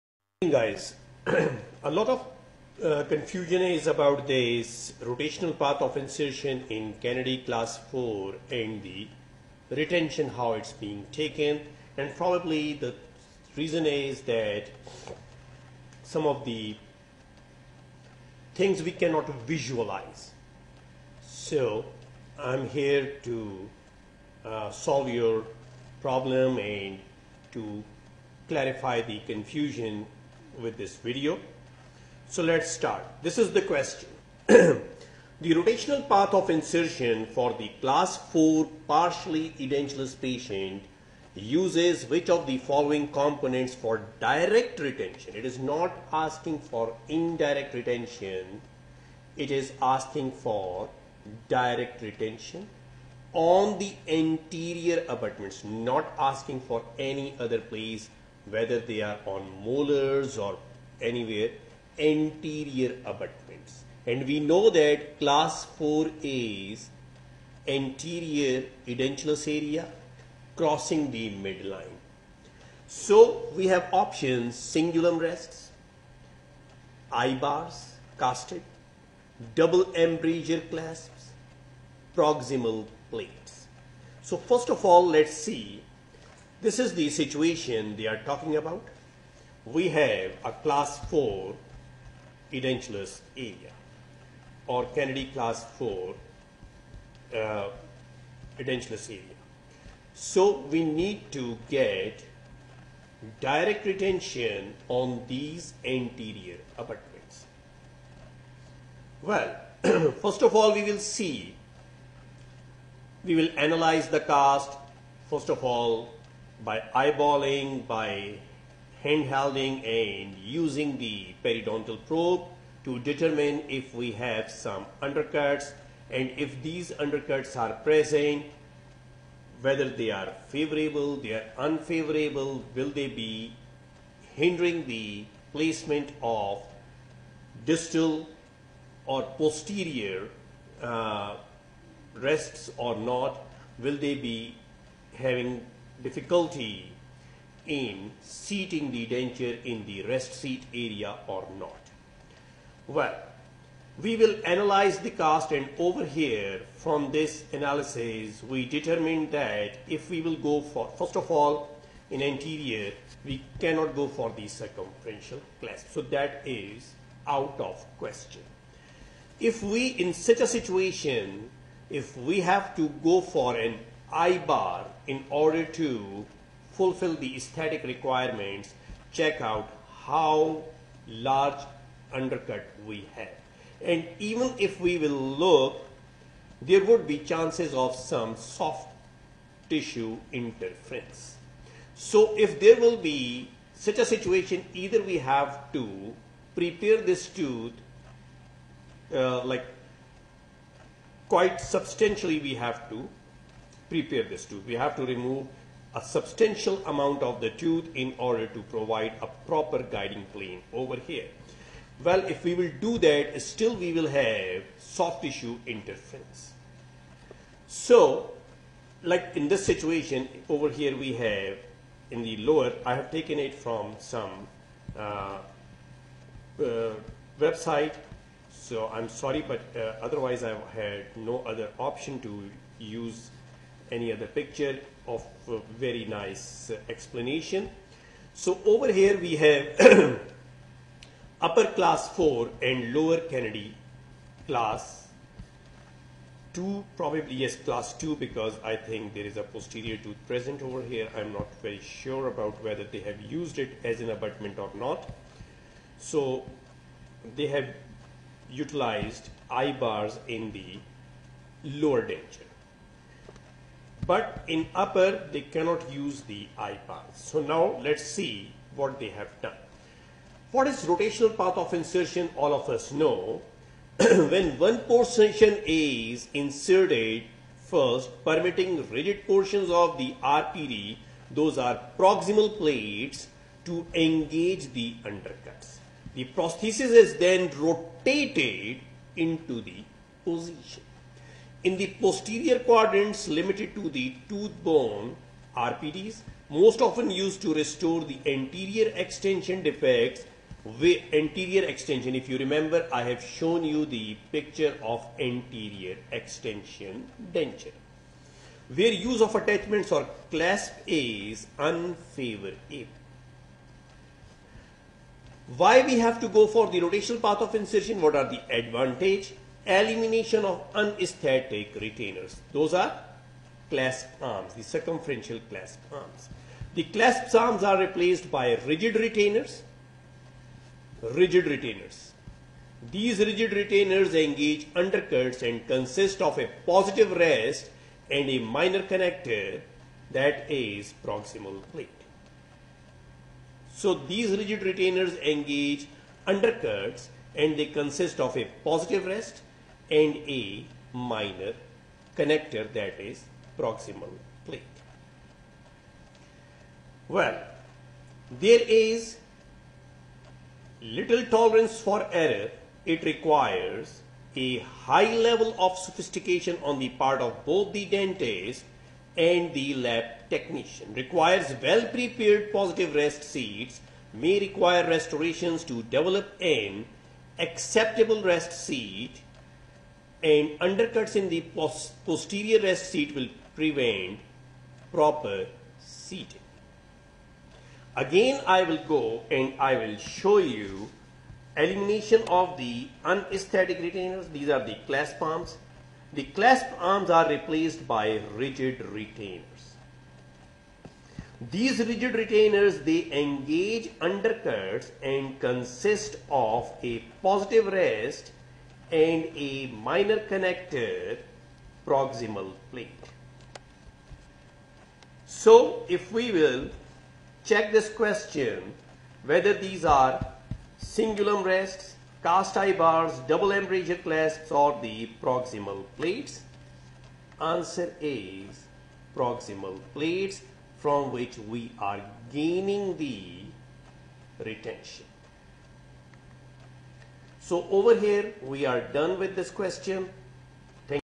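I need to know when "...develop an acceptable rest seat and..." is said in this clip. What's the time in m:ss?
6:15.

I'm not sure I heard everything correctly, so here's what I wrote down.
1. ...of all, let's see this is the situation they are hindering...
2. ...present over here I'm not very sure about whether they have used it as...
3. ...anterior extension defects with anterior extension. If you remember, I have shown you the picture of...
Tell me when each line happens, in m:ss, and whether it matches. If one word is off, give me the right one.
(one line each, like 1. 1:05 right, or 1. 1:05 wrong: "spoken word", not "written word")
1. 1:24 wrong: "talking", not "hindering"
2. 4:10 right
3. 4:58 right.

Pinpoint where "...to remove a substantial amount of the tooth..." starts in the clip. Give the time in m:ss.
3:24.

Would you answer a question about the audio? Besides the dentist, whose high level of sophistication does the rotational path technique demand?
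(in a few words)
the lab technician.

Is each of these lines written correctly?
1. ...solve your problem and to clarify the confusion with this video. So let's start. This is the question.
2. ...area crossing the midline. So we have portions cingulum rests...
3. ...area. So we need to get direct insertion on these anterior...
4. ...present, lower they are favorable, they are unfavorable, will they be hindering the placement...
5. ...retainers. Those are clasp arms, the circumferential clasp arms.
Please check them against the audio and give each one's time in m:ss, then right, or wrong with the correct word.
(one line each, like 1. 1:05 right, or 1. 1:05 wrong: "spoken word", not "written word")
1. 0:24 right
2. 1:09 wrong: "options", not "portions"
3. 1:39 wrong: "retention", not "insertion"
4. 2:07 wrong: "whether", not "lower"
5. 5:21 right.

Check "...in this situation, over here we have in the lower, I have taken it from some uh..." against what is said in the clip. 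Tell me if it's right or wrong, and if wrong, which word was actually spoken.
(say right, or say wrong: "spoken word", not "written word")
right.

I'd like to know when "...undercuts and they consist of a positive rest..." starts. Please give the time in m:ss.
5:46.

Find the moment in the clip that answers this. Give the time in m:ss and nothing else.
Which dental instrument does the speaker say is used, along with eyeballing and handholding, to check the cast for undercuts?
2:01.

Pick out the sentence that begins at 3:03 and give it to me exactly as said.
And even if we will look, there would be chances of some soft tissue interference.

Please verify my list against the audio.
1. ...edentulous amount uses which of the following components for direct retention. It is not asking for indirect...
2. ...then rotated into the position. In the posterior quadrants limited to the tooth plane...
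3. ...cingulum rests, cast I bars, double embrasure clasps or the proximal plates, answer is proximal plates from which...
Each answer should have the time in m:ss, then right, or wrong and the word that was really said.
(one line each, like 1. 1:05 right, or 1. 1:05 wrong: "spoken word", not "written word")
1. 0:39 wrong: "patient", not "amount"
2. 4:47 wrong: "borne", not "plane"
3. 7:00 right.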